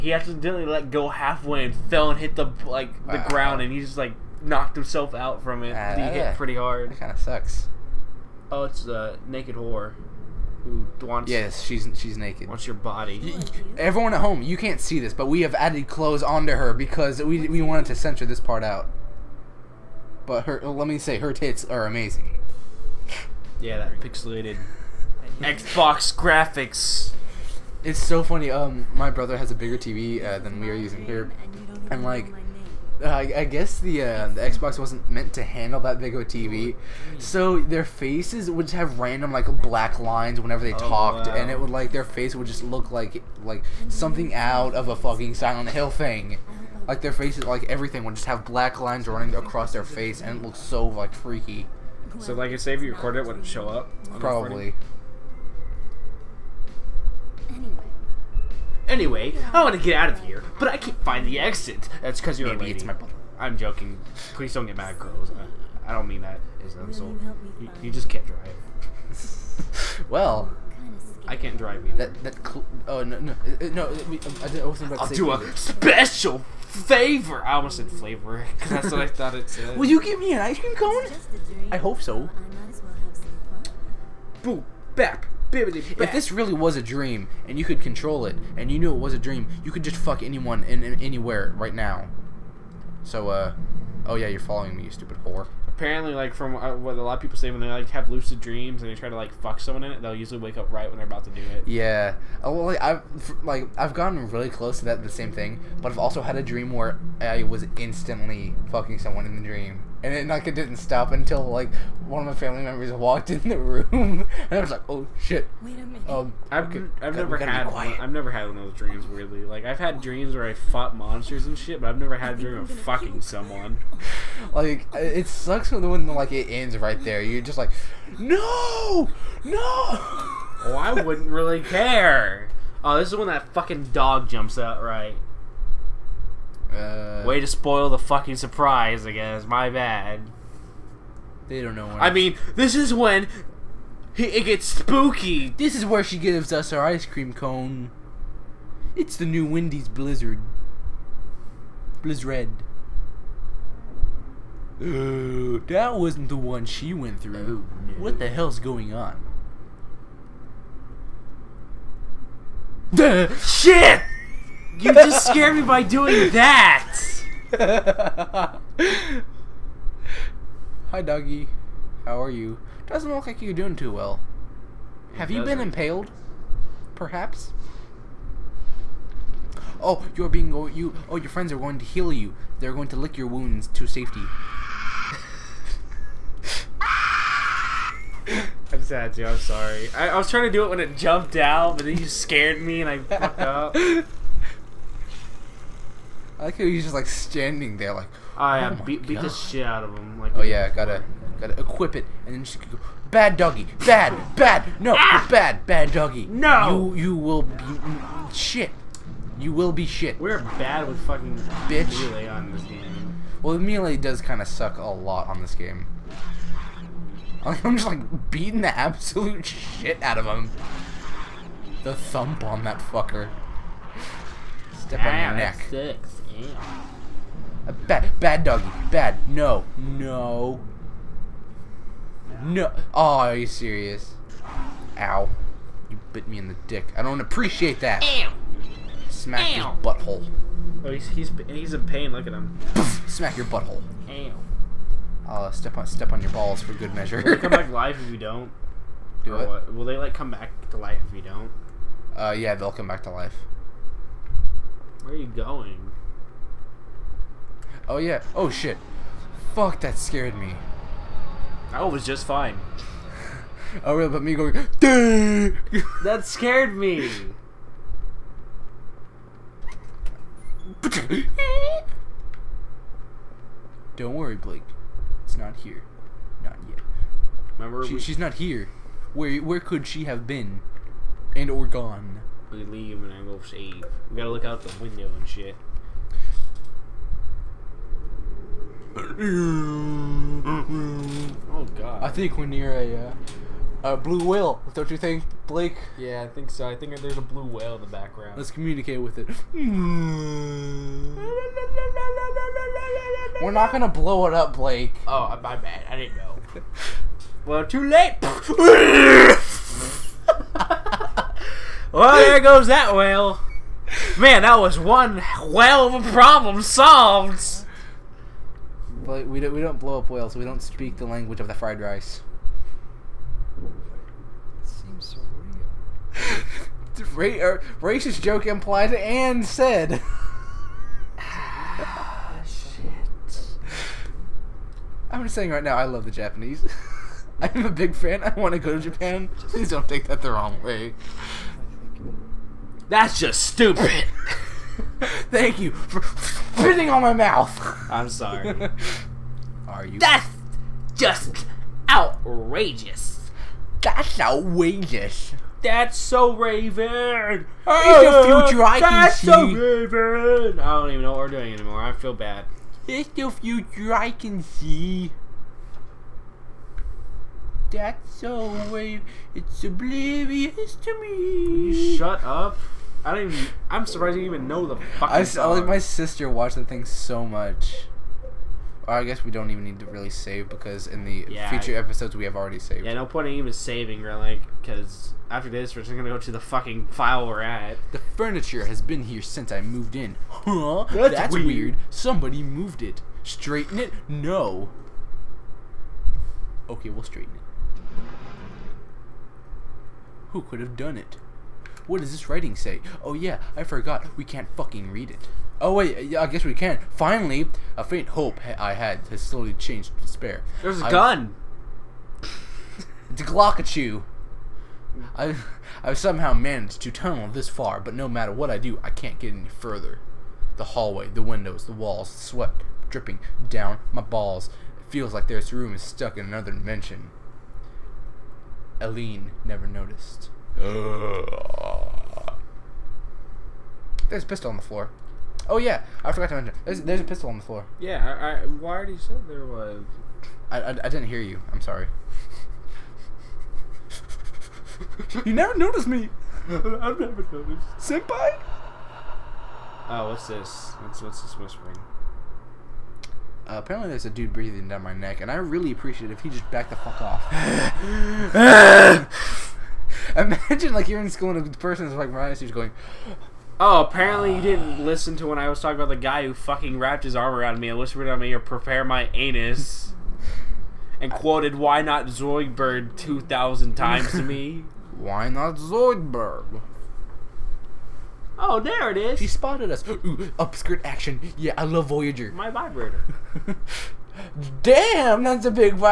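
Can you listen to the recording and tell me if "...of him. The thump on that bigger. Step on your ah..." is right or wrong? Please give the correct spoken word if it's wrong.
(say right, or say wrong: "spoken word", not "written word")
wrong: "fucker", not "bigger".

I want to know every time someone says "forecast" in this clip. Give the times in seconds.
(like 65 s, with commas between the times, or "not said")
not said.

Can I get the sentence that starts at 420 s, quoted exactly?
The hallway, the windows, the walls, sweat dripping down my balls.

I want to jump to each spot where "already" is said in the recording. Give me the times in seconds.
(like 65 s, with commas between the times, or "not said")
382 s, 438 s.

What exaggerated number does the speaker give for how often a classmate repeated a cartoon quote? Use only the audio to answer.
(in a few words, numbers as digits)
2000.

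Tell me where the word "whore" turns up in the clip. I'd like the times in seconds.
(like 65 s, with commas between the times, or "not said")
9 s, 95 s.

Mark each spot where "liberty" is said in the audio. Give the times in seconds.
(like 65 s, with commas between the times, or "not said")
not said.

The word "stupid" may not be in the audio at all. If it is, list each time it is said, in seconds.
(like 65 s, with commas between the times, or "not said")
94 s, 343 s.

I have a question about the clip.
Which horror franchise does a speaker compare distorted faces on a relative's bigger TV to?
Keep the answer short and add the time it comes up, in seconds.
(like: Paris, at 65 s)
Silent Hill, at 45 s.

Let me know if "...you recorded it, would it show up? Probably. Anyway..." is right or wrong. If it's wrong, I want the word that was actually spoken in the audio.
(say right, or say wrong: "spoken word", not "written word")
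right.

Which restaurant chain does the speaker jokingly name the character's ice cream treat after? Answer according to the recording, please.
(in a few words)
Wendy's.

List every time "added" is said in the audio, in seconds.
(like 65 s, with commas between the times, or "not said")
15 s.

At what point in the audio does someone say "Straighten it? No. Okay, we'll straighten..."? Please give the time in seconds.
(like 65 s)
393 s.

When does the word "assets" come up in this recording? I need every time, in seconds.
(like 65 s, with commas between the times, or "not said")
not said.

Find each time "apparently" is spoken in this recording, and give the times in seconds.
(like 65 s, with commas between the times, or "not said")
95 s, 453 s, 463 s.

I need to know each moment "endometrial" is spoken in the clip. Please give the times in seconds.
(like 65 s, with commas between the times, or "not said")
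not said.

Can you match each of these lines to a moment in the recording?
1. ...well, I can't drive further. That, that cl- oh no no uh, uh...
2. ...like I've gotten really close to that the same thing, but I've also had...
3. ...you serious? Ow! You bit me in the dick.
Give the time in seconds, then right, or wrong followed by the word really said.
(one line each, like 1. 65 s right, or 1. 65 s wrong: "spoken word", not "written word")
1. 70 s wrong: "either", not "further"
2. 103 s right
3. 233 s right.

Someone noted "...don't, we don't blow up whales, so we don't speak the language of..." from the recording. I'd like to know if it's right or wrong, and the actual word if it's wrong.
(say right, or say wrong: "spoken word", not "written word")
right.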